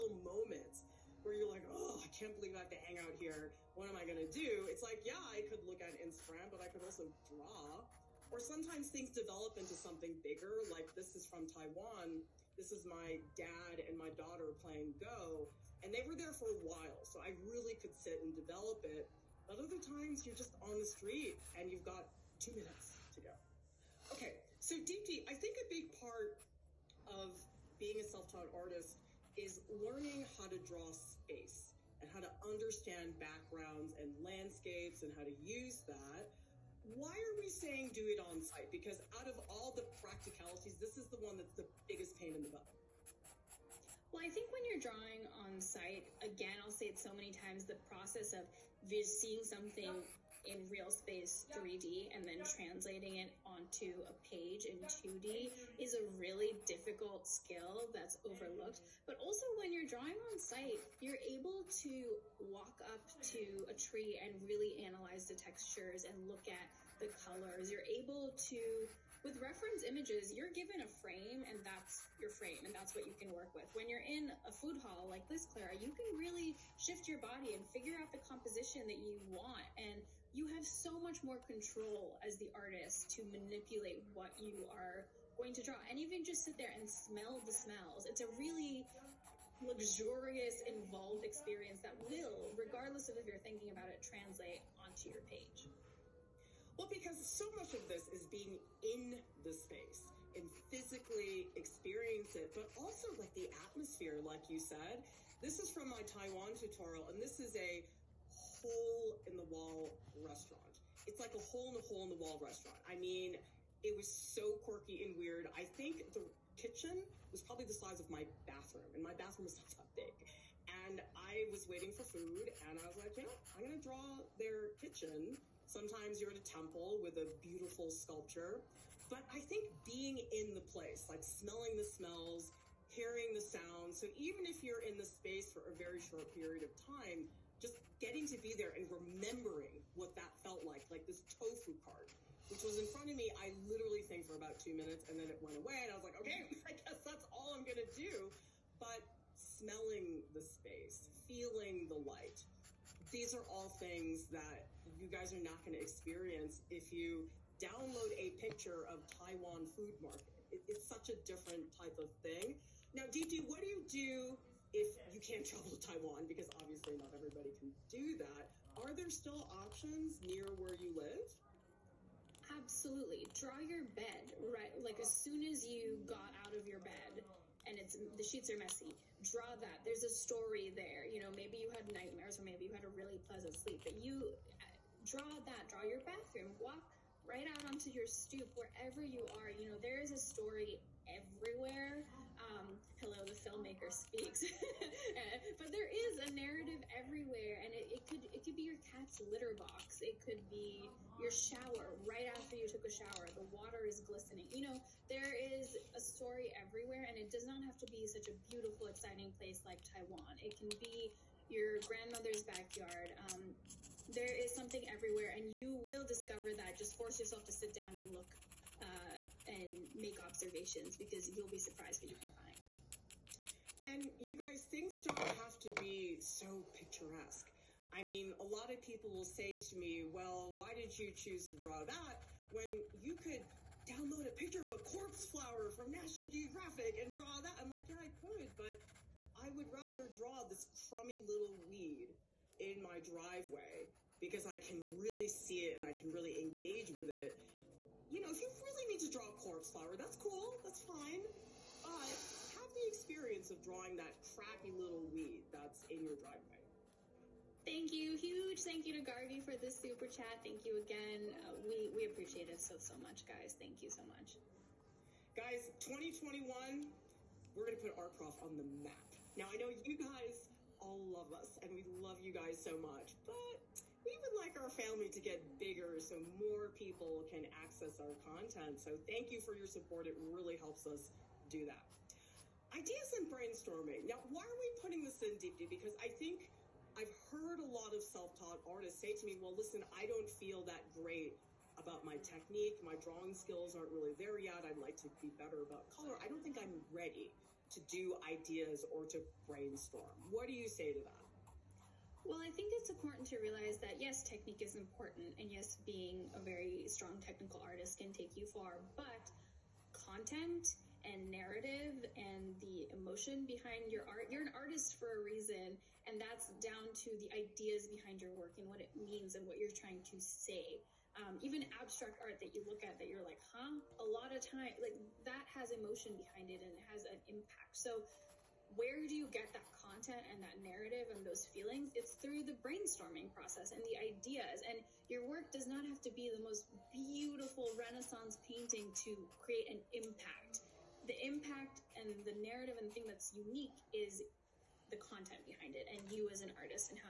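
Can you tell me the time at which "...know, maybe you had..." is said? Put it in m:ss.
3:01.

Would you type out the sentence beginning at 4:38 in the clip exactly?
So thank you for your support.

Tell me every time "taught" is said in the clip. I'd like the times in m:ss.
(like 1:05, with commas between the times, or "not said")
0:28, 4:48.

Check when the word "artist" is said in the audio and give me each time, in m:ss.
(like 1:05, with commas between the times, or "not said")
0:28, 1:22, 4:48, 5:07, 5:14.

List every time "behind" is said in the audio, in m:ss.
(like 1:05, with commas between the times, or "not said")
5:13, 5:17, 5:26, 5:45.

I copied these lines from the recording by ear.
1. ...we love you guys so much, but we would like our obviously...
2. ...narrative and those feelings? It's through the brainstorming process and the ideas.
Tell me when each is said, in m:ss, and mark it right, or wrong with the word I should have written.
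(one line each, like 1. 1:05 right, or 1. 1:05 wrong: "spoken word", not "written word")
1. 4:31 wrong: "family", not "obviously"
2. 5:30 right.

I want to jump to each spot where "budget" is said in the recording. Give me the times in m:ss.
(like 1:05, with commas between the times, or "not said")
not said.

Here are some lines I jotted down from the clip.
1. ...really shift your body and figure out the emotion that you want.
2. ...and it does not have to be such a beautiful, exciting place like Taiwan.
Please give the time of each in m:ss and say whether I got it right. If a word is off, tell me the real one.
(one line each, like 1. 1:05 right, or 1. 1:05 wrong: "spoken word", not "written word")
1. 1:16 wrong: "composition", not "emotion"
2. 3:27 right.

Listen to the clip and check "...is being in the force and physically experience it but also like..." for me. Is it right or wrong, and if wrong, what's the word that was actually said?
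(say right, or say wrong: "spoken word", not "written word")
wrong: "space", not "force".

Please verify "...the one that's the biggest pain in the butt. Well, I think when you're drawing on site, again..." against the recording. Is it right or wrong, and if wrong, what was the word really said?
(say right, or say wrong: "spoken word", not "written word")
right.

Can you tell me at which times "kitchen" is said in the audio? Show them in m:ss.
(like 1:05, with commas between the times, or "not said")
1:56, 2:04.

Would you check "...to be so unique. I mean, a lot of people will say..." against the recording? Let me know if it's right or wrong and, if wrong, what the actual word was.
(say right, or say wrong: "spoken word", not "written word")
wrong: "picturesque", not "unique".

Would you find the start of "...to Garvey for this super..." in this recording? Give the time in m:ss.
4:19.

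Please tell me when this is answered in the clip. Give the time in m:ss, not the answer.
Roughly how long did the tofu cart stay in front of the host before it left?
2:24.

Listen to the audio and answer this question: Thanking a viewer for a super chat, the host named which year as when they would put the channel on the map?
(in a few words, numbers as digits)
2021.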